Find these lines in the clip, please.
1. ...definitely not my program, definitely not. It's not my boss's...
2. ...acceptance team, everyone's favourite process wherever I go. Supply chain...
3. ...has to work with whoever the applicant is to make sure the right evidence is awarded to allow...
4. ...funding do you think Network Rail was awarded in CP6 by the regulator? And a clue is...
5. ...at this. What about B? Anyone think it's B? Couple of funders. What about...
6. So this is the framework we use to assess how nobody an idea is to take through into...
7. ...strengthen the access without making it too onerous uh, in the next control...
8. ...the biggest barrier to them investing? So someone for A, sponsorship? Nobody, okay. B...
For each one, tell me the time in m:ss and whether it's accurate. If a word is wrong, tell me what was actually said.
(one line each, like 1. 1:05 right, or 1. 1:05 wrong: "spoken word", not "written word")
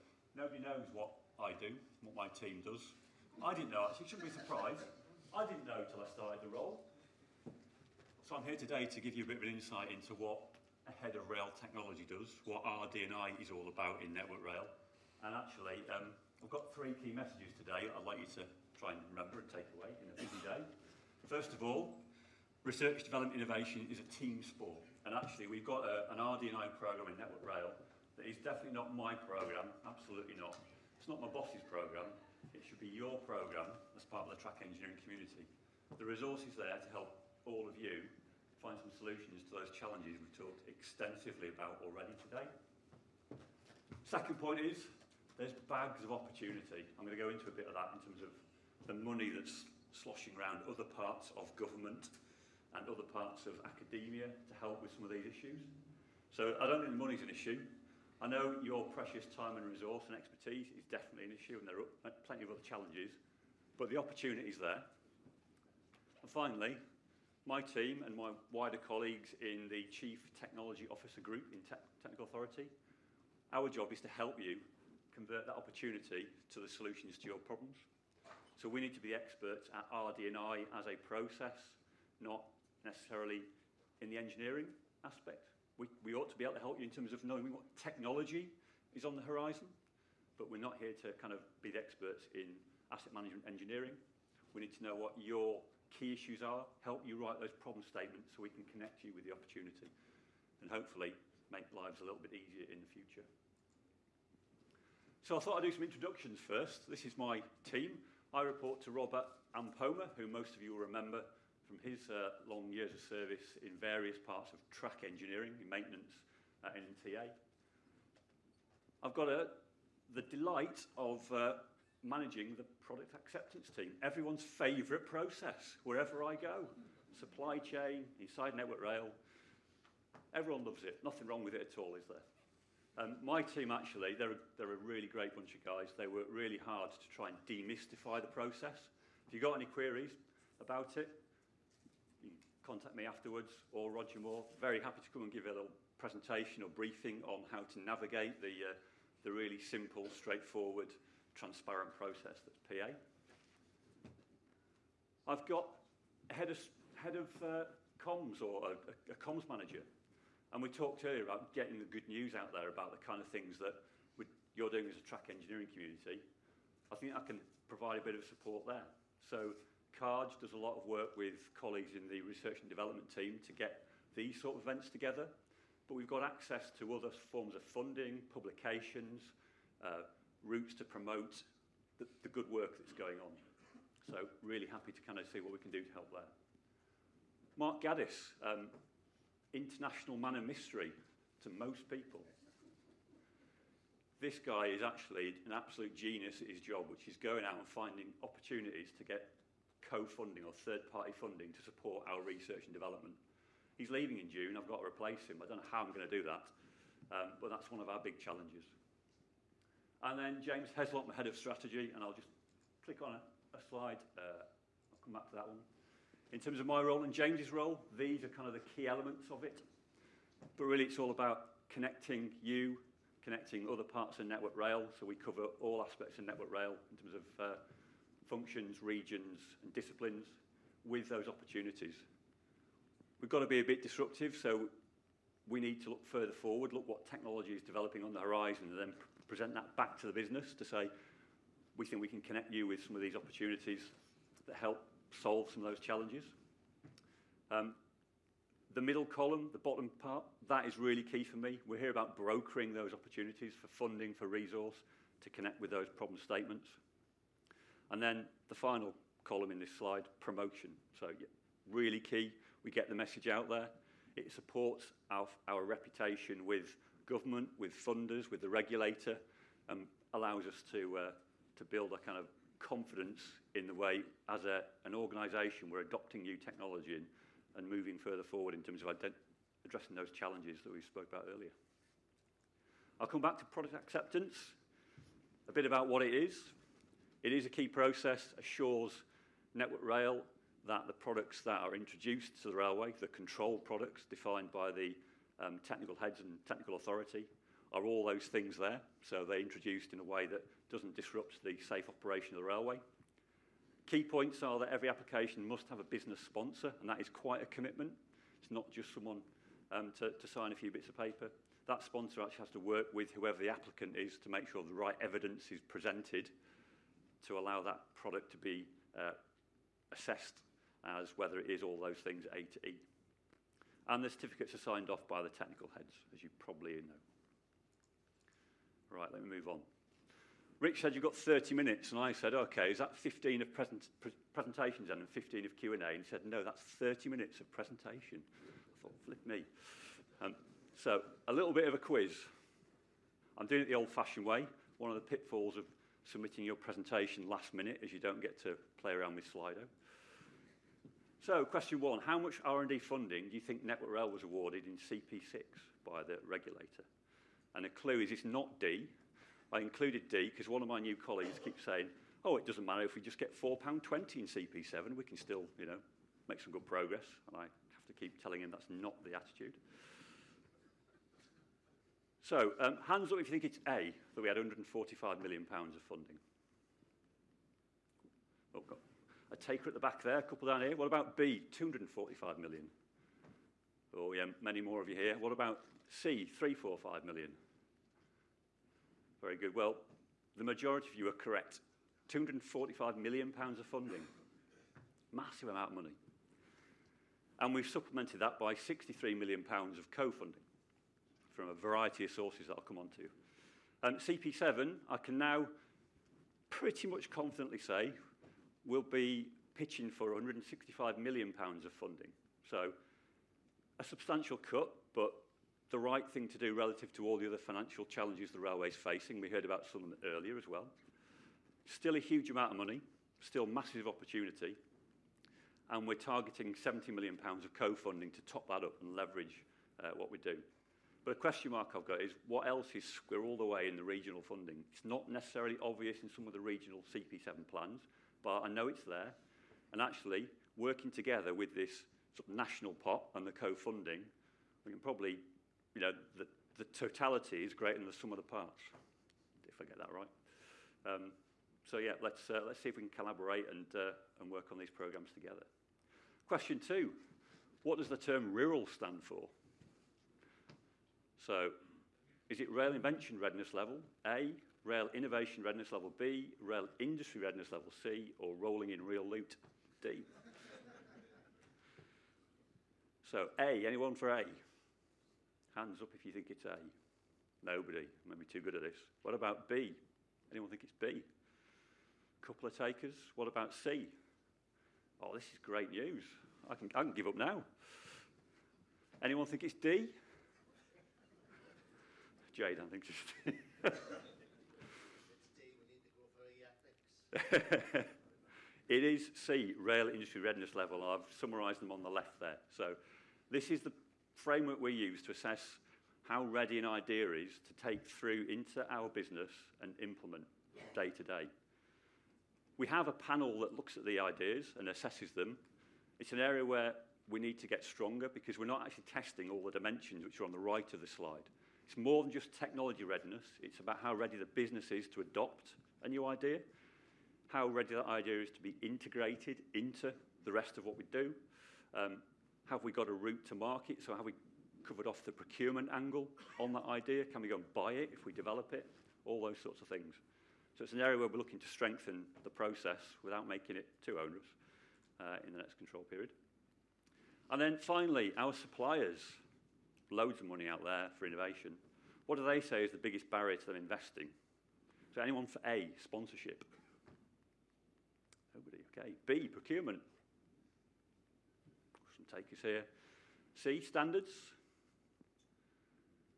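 1. 0:28 wrong: "absolutely", not "definitely"
2. 2:03 right
3. 5:12 wrong: "presented", not "awarded"
4. 5:52 right
5. 7:58 wrong: "takers", not "funders"
6. 8:22 wrong: "ready", not "nobody"
7. 9:01 wrong: "process", not "access"
8. 9:12 wrong: "anyone", not "someone".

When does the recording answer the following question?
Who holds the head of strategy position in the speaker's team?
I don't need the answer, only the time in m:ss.
3:30.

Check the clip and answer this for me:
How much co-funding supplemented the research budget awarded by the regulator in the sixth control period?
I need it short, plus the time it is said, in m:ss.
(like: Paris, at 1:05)
£63 million, at 6:38.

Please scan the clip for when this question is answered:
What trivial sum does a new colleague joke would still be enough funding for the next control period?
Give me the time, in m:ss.
6:03.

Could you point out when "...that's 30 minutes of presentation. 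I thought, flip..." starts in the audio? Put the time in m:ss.
5:36.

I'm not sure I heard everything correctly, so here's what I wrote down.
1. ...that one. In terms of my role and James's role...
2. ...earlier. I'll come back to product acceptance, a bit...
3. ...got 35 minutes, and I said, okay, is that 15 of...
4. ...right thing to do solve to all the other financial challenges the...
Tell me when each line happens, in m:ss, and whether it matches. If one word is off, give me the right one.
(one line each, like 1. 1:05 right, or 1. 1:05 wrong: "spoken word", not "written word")
1. 3:35 right
2. 4:41 right
3. 5:31 wrong: "30", not "35"
4. 6:55 wrong: "relative", not "solve".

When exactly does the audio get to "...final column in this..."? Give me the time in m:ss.
4:18.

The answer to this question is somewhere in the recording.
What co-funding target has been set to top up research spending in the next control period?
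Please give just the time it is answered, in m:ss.
7:06.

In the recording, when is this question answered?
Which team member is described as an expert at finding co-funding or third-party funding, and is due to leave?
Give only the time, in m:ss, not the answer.
3:07.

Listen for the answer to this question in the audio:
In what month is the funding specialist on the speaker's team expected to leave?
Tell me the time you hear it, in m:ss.
3:24.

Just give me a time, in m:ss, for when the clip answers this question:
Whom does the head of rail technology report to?
1:48.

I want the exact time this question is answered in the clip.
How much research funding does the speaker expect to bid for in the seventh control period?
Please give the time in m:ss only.
6:50.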